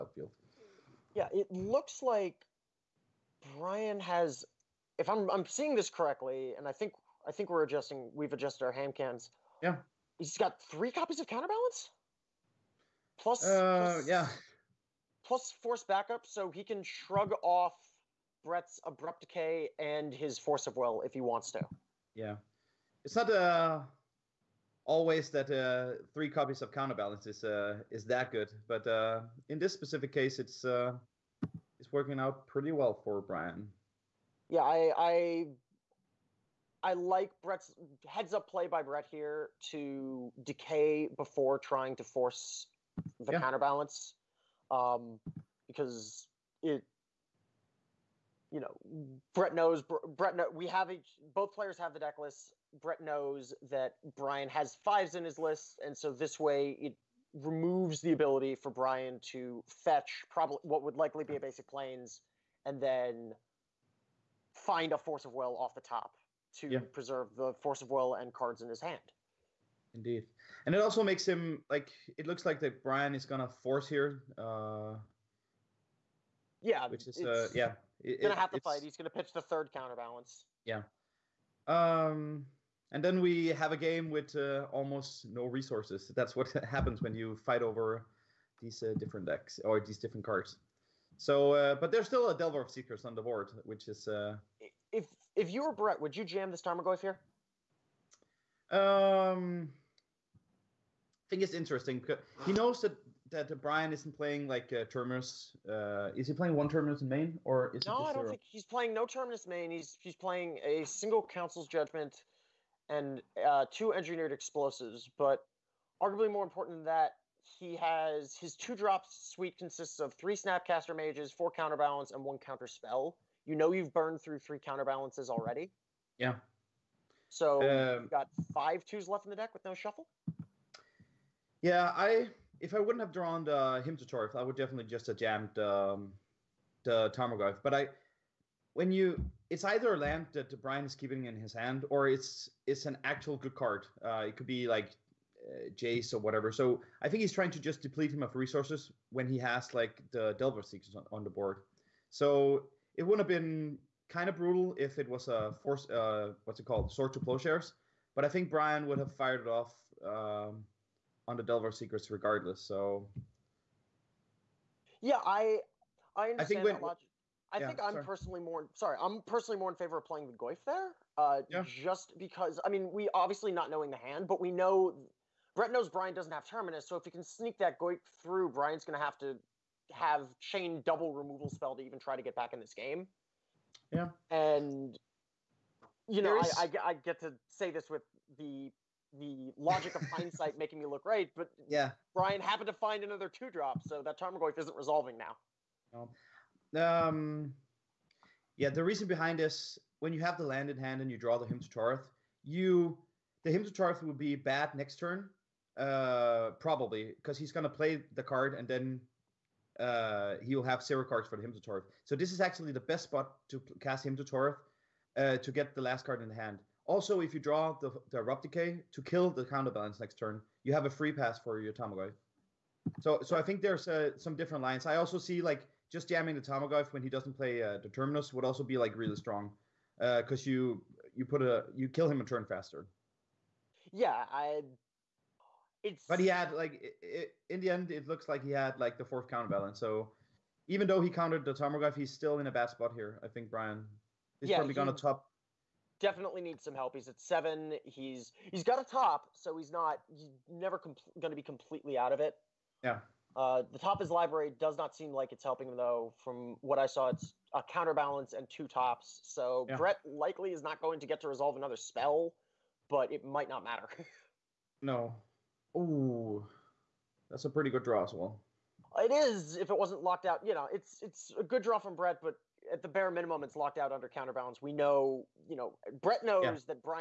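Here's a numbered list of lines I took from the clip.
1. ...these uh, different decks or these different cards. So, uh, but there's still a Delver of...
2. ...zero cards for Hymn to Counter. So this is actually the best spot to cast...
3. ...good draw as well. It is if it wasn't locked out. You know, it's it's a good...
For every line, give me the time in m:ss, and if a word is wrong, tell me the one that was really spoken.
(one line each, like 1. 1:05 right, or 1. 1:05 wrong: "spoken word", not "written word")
1. 1:28 right
2. 3:30 wrong: "Tourach", not "Counter"
3. 4:27 right.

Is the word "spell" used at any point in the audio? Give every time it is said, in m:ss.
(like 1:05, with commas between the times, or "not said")
2:02, 3:01, 4:21.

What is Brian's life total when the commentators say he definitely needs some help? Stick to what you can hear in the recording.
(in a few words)
7.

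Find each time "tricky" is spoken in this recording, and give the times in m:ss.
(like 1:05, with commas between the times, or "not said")
not said.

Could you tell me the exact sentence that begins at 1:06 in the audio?
preserve the force of will and cards in his hand.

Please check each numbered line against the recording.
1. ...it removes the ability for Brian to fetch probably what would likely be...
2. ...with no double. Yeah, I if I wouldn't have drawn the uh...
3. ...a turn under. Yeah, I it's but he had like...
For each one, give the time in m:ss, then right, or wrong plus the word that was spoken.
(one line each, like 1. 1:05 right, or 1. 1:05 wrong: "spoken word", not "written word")
1. 0:56 right
2. 2:09 wrong: "shuffle", not "double"
3. 3:52 wrong: "faster", not "under".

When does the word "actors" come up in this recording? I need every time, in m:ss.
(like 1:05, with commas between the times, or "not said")
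not said.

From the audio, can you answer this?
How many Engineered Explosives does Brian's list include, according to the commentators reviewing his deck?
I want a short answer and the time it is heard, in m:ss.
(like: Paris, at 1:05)
2, at 1:53.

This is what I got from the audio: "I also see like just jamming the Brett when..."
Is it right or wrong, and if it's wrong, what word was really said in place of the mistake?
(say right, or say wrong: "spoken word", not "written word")
wrong: "Tarmogoyf", not "Brett".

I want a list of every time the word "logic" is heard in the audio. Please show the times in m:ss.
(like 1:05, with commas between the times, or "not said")
2:46, 3:09.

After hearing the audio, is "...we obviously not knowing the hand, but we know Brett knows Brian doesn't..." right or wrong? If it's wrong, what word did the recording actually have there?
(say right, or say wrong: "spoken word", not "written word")
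right.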